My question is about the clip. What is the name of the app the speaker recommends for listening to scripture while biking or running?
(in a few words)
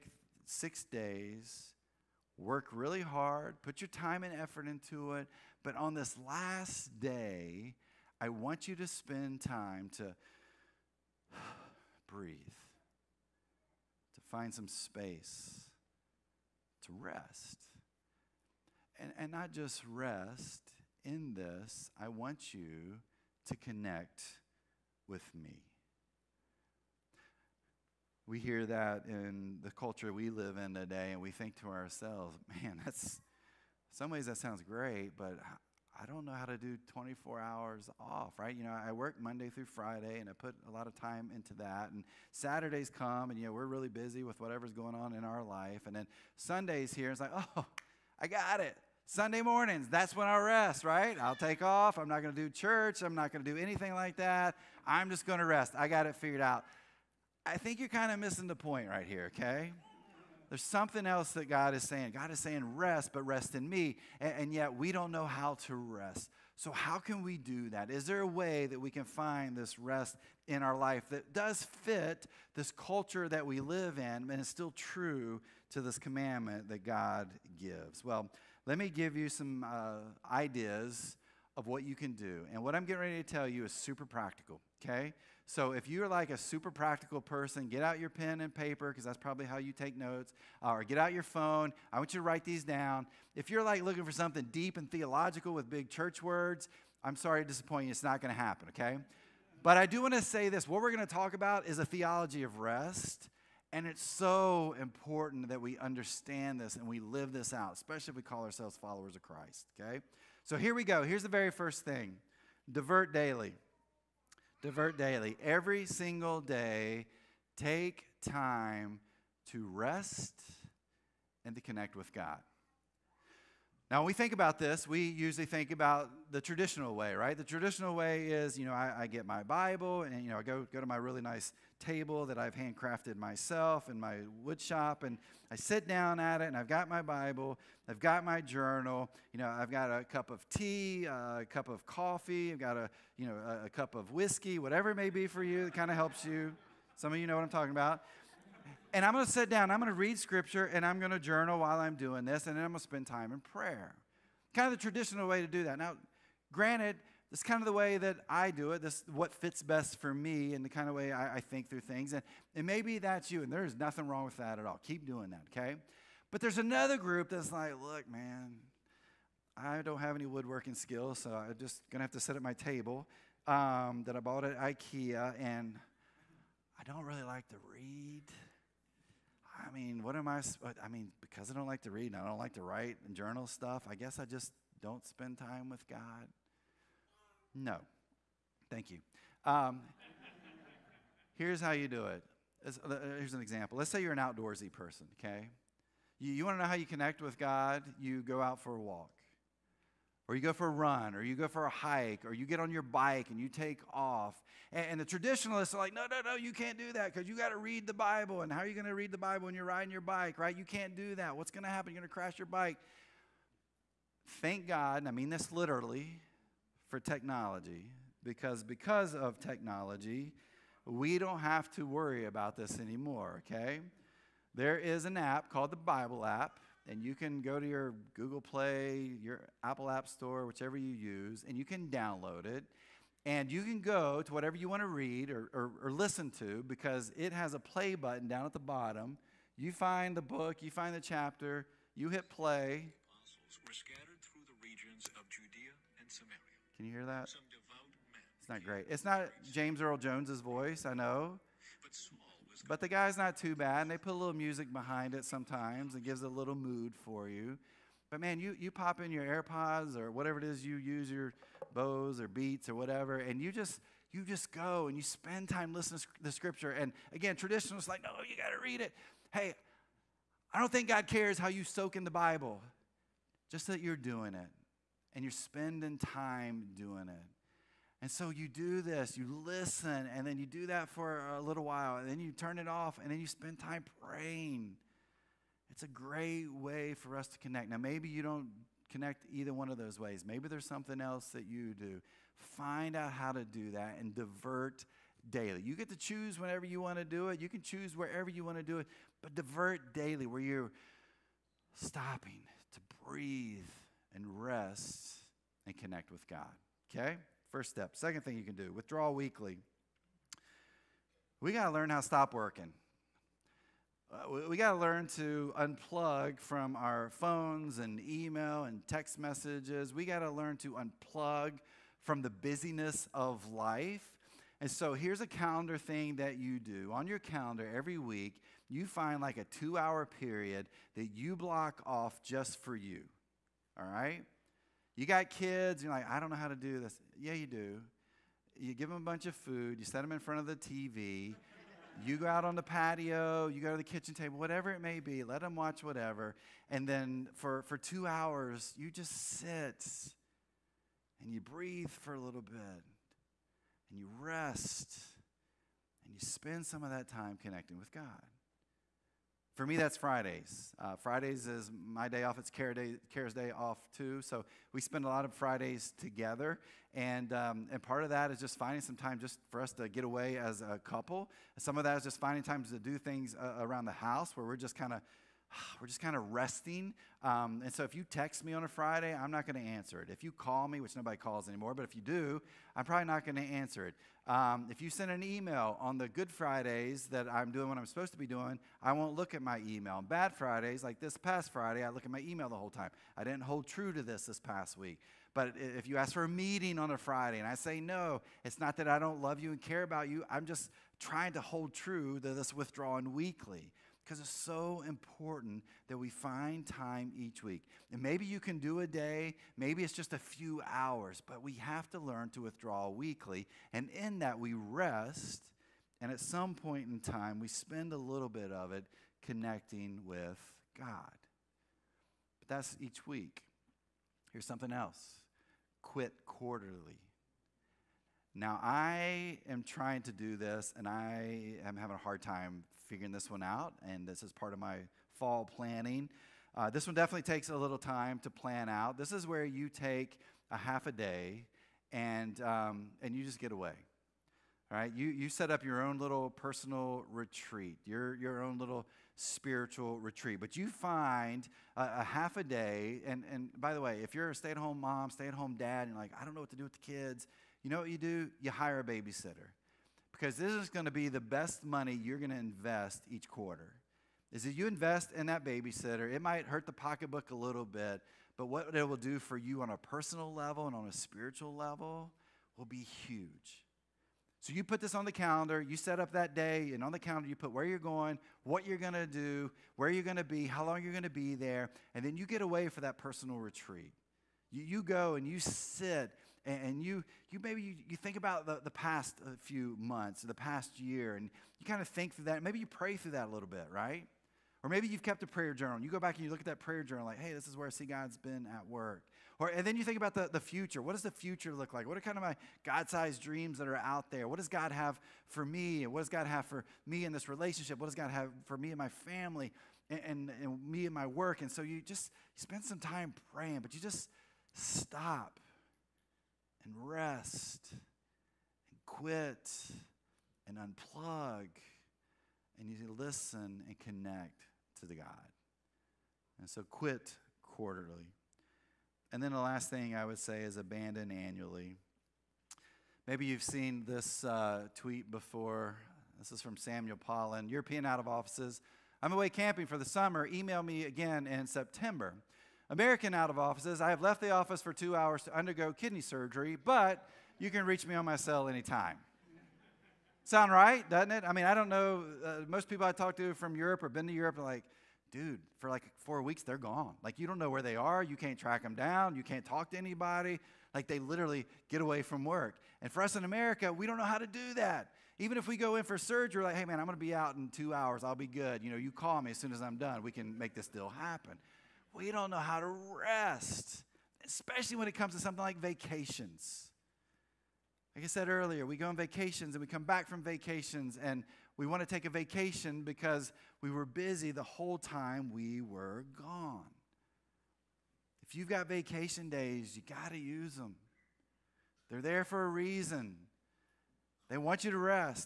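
the Bible app.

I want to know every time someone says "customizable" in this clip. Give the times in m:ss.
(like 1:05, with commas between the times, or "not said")
not said.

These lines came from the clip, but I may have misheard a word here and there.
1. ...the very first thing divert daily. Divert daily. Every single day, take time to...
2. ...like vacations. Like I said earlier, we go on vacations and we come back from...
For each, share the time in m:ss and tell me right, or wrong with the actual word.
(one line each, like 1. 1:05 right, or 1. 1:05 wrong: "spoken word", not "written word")
1. 1:51 right
2. 9:35 right.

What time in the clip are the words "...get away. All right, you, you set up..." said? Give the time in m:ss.
7:23.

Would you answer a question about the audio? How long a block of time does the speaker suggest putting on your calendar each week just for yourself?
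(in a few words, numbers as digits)
2 hours.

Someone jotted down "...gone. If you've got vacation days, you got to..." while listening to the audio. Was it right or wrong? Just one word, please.
right.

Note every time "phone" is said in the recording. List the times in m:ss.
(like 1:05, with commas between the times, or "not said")
1:31, 5:17.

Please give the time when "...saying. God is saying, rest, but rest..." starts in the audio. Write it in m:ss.
1:01.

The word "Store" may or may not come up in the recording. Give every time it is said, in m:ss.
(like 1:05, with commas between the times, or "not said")
3:50.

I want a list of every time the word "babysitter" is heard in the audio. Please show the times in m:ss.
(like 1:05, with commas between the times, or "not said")
7:38, 7:45.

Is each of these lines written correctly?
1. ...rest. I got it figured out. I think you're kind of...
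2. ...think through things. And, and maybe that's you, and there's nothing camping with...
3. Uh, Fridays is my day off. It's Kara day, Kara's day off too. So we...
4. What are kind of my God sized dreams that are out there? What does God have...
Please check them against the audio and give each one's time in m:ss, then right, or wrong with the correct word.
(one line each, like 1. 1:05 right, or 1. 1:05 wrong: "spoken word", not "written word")
1. 0:55 right
2. 2:41 wrong: "wrong", not "camping"
3. 6:00 right
4. 8:21 right.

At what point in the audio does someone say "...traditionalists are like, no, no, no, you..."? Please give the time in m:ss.
3:25.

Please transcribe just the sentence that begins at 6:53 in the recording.
And in that, we rest, and at some point in time, we spend a little bit of it connecting with God.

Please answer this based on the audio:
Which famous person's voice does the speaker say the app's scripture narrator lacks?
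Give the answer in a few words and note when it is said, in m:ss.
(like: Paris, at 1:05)
James Earl Jones, at 4:09.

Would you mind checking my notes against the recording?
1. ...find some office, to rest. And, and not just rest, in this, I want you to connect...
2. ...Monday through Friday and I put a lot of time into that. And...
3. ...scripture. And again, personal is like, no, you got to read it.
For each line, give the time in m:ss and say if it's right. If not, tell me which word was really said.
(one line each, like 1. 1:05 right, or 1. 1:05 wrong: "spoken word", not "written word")
1. 0:14 wrong: "space", not "office"
2. 0:39 right
3. 4:26 wrong: "traditional", not "personal".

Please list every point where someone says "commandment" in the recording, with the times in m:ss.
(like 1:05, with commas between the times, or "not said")
1:15.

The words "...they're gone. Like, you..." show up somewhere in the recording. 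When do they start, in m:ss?
9:16.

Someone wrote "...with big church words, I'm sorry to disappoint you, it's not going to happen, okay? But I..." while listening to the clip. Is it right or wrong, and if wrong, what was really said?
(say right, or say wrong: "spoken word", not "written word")
right.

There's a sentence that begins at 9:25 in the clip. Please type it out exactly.
Even if we go in for surgery, like, hey, man, I'm going to be out in two hours.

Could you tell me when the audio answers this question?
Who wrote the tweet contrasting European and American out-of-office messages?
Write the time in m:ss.
8:56.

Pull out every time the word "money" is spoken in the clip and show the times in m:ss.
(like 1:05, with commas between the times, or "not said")
7:41.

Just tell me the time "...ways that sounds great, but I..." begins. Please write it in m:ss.
0:34.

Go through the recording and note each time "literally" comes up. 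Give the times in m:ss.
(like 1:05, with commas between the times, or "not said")
3:35, 9:20.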